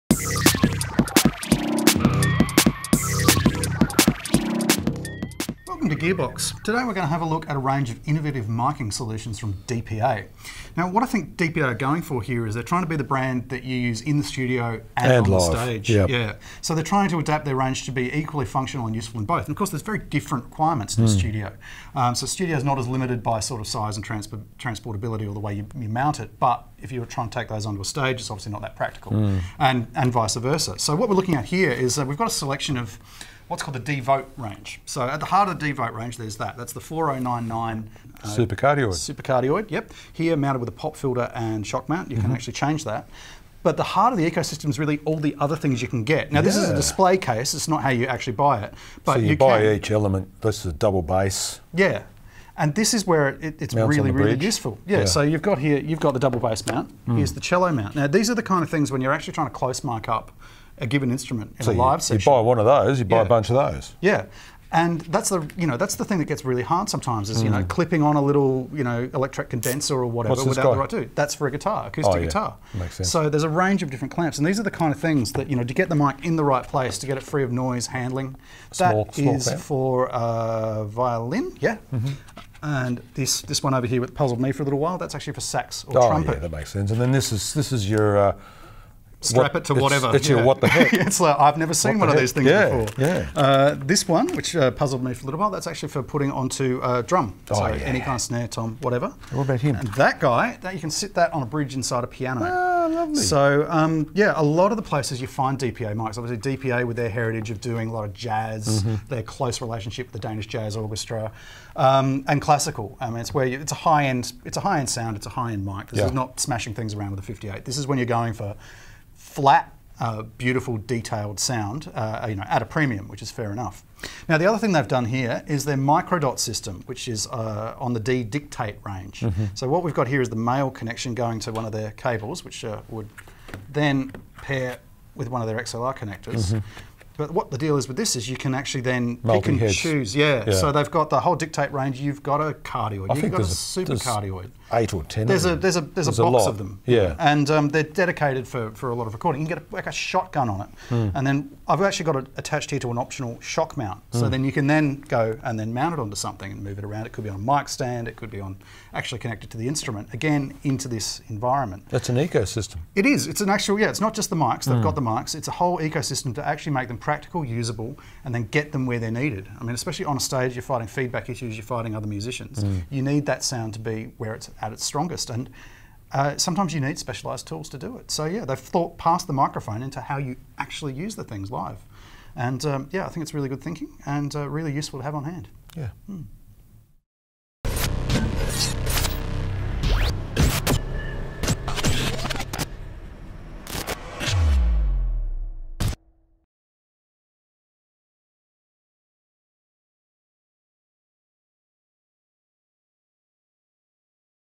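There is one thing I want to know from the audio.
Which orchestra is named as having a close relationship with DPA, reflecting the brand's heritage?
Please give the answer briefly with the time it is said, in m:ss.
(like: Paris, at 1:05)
Danish Jazz Orchestra, at 1:50.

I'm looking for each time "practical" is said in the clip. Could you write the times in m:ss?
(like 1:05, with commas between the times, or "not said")
0:28, 2:46.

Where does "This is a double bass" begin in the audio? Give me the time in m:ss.
0:50.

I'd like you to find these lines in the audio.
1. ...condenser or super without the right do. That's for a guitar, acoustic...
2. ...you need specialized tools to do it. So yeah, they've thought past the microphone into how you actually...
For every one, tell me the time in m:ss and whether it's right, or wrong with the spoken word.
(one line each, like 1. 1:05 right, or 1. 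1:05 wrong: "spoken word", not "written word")
1. 1:09 wrong: "whatever", not "super"
2. 2:56 right.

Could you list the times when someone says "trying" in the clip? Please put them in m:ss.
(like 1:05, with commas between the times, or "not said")
0:12, 0:16, 0:27, 0:59.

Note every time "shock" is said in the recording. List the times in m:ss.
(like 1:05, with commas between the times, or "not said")
0:41, 2:33.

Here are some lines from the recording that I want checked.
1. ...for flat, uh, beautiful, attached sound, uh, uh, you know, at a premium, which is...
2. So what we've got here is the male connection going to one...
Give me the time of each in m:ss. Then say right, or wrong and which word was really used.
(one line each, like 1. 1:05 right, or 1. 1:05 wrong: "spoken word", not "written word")
1. 1:58 wrong: "detailed", not "attached"
2. 2:09 right.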